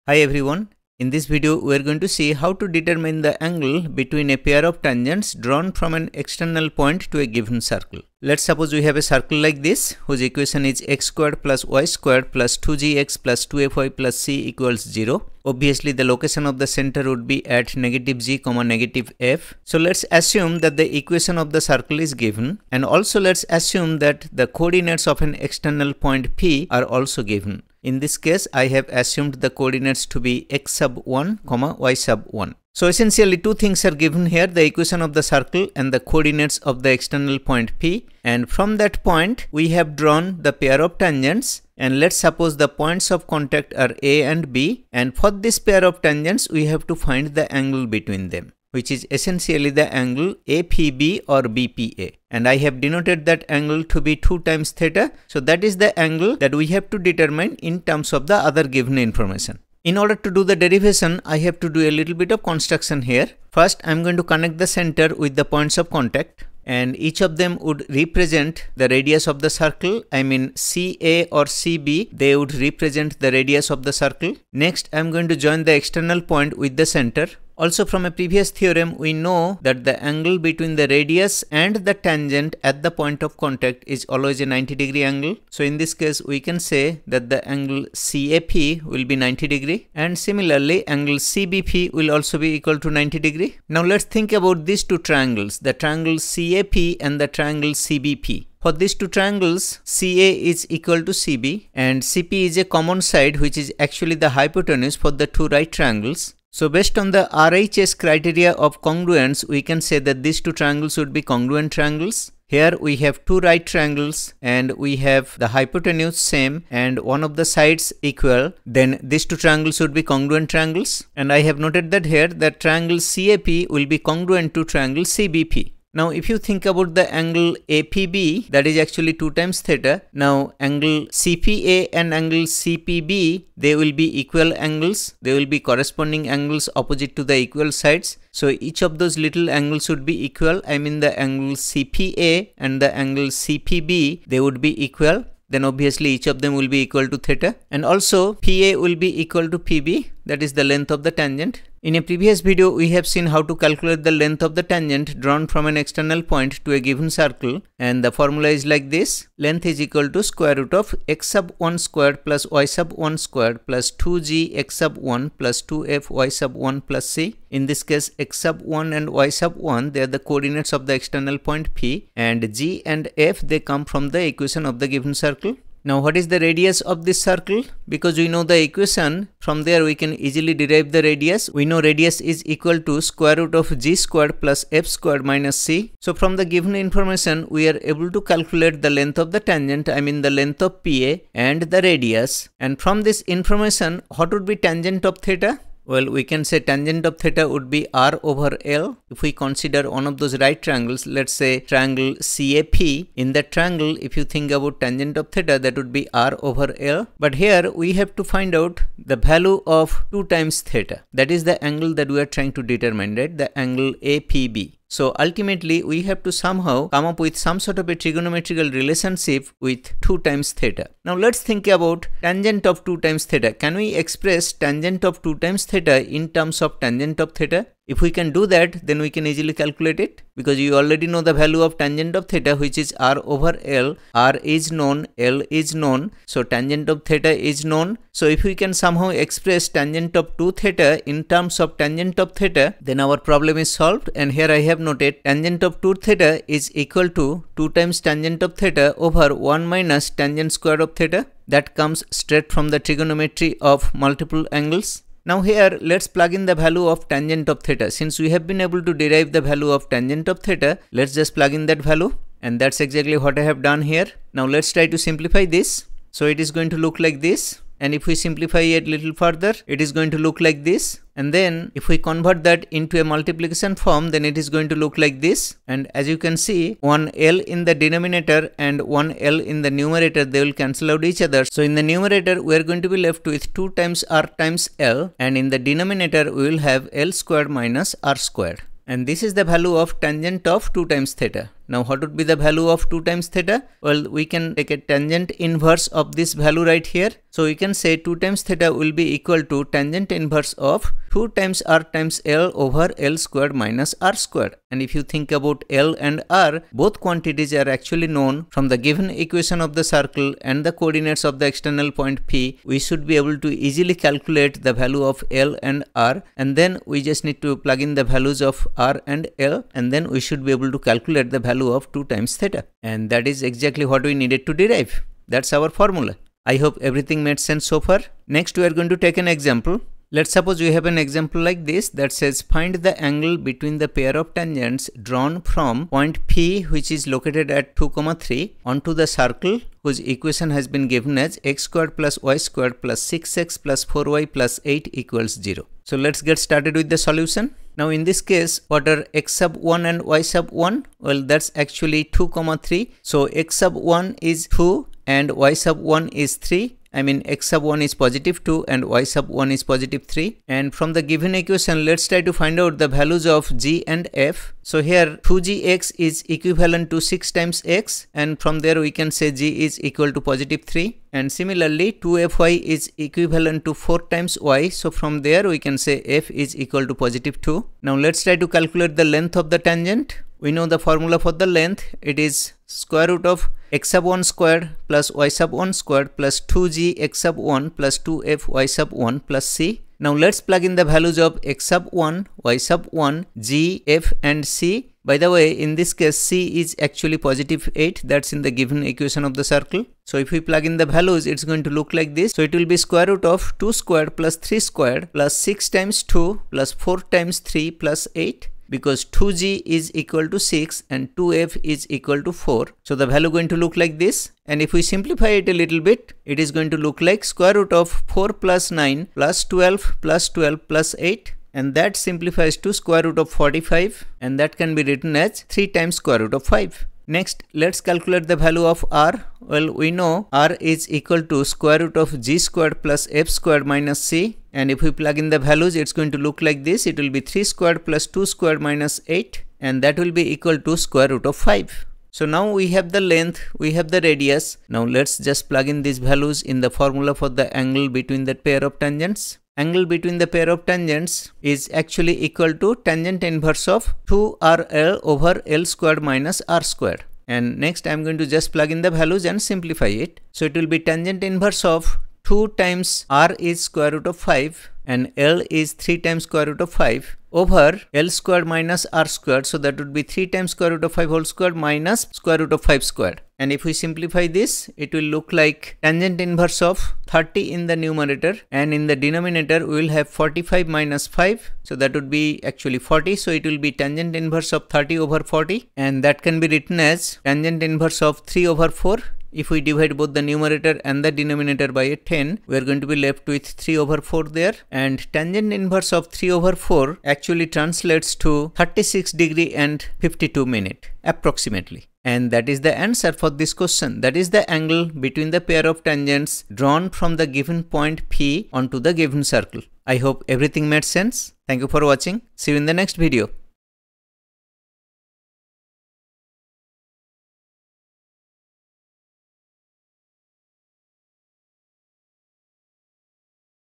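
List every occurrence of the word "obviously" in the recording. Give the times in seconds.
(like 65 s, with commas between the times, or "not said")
15 s, 145 s.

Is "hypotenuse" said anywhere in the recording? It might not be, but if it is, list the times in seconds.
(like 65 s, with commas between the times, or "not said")
104 s, 115 s.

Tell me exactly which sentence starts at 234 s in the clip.
r is known, l is known.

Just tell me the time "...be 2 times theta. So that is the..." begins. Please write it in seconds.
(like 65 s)
53 s.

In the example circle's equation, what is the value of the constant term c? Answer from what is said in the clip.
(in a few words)
8.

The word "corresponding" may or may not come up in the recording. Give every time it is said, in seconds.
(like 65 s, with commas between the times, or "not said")
135 s.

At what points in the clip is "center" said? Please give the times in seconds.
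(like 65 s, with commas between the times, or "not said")
16 s, 64 s, 76 s.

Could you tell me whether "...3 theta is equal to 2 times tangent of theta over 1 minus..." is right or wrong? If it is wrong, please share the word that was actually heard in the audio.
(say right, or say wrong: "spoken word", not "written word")
wrong: "2", not "3".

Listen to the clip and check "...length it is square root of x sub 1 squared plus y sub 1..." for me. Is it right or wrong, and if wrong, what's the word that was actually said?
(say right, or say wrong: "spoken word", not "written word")
right.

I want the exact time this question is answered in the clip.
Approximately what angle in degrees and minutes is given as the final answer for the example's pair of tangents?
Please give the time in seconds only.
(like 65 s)
498 s.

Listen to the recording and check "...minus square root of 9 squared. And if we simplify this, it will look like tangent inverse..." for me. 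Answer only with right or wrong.
wrong.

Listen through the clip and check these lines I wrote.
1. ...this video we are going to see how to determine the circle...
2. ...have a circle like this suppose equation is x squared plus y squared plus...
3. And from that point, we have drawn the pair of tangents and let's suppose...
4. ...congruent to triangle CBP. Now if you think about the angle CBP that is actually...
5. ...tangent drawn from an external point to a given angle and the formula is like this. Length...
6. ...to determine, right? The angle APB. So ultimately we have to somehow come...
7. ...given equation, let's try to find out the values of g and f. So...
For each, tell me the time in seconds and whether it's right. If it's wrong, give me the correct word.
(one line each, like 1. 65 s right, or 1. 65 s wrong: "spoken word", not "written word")
1. 1 s wrong: "angle", not "circle"
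2. 8 s wrong: "whose", not "suppose"
3. 38 s right
4. 123 s wrong: "APB", not "CBP"
5. 154 s wrong: "circle", not "angle"
6. 212 s right
7. 361 s right.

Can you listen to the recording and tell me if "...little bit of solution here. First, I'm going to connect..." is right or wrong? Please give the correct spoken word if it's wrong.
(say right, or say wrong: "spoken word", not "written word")
wrong: "construction", not "solution".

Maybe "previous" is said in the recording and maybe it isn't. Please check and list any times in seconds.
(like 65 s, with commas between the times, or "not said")
78 s, 152 s.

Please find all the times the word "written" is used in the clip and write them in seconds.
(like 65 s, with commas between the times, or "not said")
424 s, 486 s.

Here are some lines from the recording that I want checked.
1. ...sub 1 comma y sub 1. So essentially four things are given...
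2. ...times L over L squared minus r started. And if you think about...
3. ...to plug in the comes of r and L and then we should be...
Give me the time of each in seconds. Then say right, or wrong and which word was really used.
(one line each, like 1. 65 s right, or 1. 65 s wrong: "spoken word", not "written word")
1. 30 s wrong: "two", not "four"
2. 301 s wrong: "squared", not "started"
3. 317 s wrong: "values", not "comes".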